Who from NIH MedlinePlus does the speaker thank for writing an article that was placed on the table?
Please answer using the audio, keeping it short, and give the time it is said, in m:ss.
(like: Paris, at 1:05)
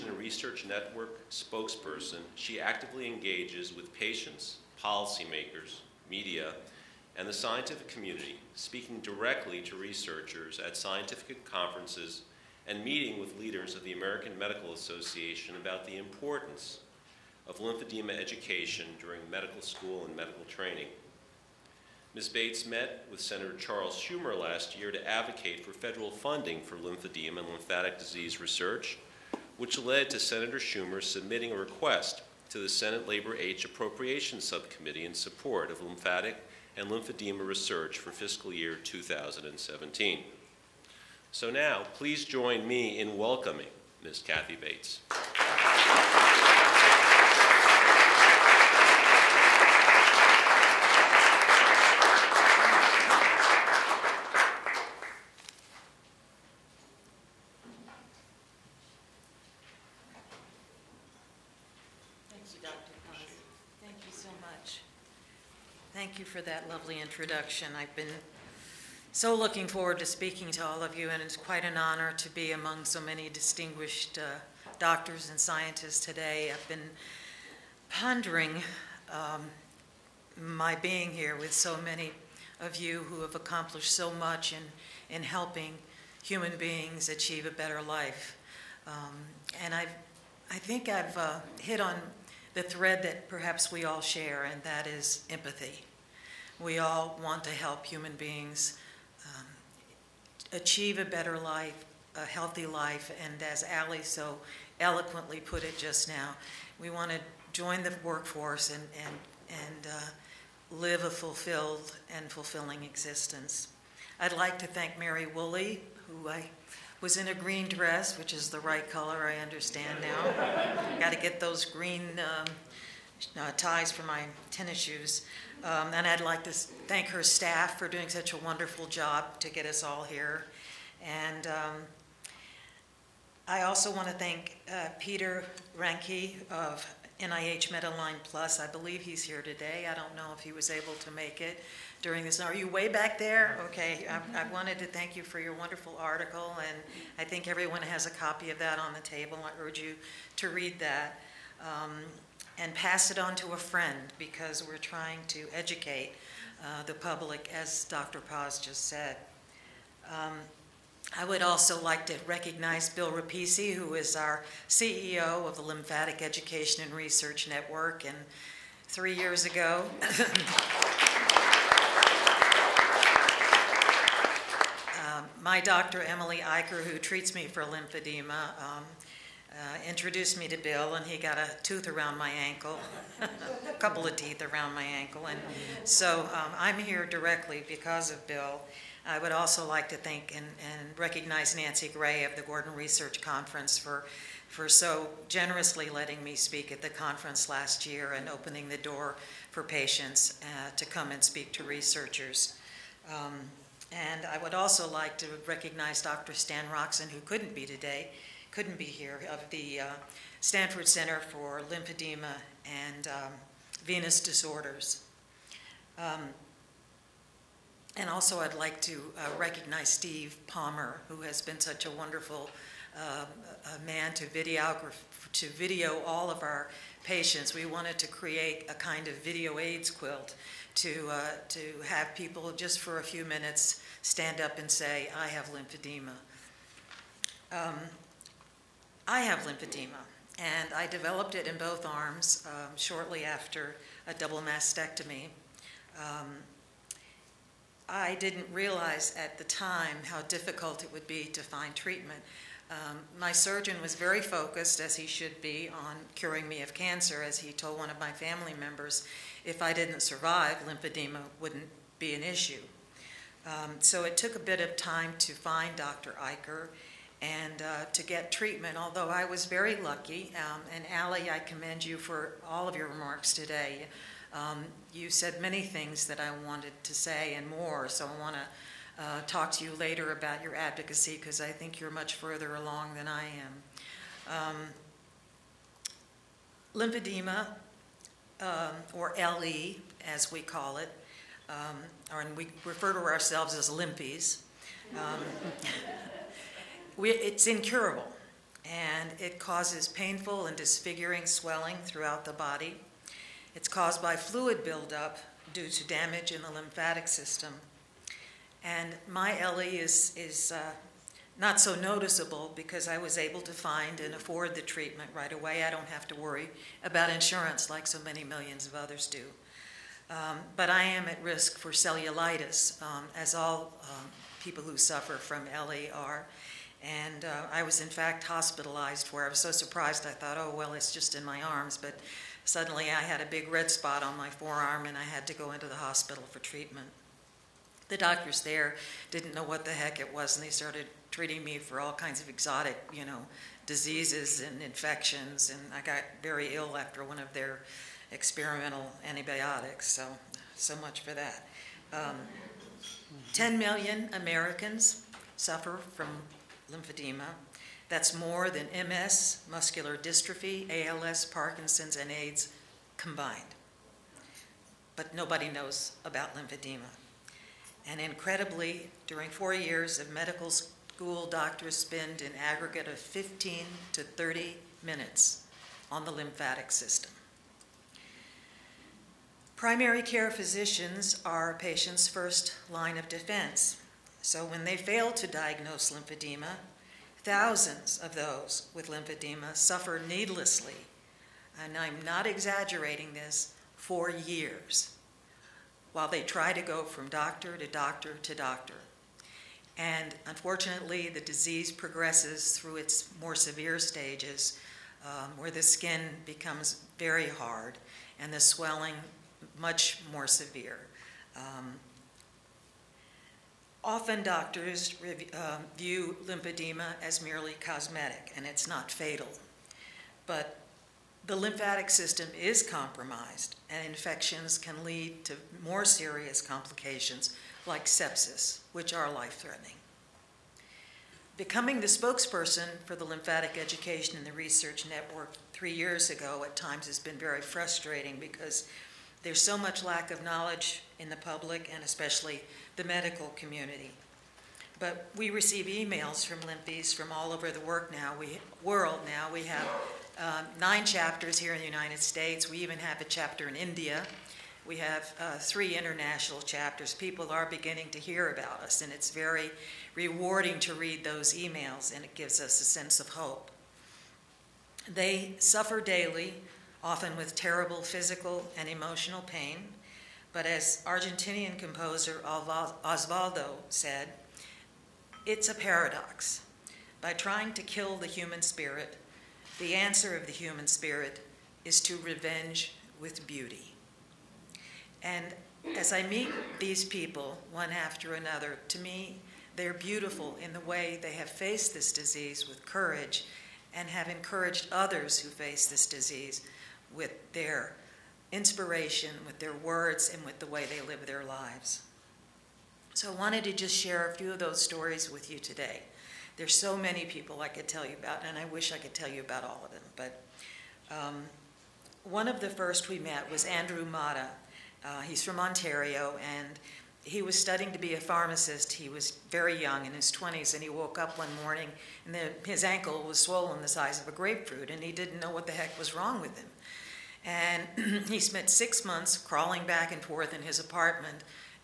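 Peter Ranke, at 2:14.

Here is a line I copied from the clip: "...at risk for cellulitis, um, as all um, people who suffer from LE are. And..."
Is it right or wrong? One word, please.
right.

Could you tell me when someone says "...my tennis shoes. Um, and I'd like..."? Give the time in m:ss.
2:04.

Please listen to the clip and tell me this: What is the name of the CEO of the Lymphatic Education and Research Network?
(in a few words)
Bill Repicci.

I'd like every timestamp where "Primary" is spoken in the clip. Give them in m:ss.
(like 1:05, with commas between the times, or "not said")
6:19.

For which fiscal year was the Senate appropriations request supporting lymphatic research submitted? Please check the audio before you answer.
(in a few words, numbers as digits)
2017.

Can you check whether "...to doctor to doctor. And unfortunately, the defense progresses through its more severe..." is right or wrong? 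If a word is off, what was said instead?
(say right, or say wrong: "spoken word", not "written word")
wrong: "disease", not "defense".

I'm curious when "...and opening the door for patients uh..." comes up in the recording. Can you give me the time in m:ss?
3:18.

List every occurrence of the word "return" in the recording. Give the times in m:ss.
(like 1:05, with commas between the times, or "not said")
not said.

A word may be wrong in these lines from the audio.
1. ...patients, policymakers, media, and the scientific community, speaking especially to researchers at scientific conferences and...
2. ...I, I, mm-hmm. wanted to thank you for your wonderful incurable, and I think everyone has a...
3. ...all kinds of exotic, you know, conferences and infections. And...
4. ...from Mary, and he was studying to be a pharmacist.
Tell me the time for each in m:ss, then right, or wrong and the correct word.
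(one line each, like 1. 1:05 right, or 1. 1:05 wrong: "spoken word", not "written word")
1. 0:03 wrong: "directly", not "especially"
2. 2:24 wrong: "article", not "incurable"
3. 5:41 wrong: "diseases", not "conferences"
4. 8:35 wrong: "Ontario", not "Mary".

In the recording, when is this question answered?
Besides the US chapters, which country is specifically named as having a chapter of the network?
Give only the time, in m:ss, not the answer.
7:33.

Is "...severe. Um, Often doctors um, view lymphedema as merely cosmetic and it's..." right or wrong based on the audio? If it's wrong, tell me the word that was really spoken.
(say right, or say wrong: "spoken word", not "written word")
right.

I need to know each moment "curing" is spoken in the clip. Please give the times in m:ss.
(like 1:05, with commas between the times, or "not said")
4:16.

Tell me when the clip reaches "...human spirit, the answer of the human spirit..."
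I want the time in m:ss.
7:58.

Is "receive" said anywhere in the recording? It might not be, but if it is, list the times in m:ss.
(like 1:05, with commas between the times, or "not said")
7:25.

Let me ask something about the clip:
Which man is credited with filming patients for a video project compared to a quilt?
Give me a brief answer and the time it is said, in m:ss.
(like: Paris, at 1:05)
Steve Palmer, at 3:39.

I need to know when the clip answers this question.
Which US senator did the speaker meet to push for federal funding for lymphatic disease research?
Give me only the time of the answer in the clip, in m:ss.
0:23.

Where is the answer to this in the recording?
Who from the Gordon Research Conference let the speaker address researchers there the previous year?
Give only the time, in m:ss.
3:11.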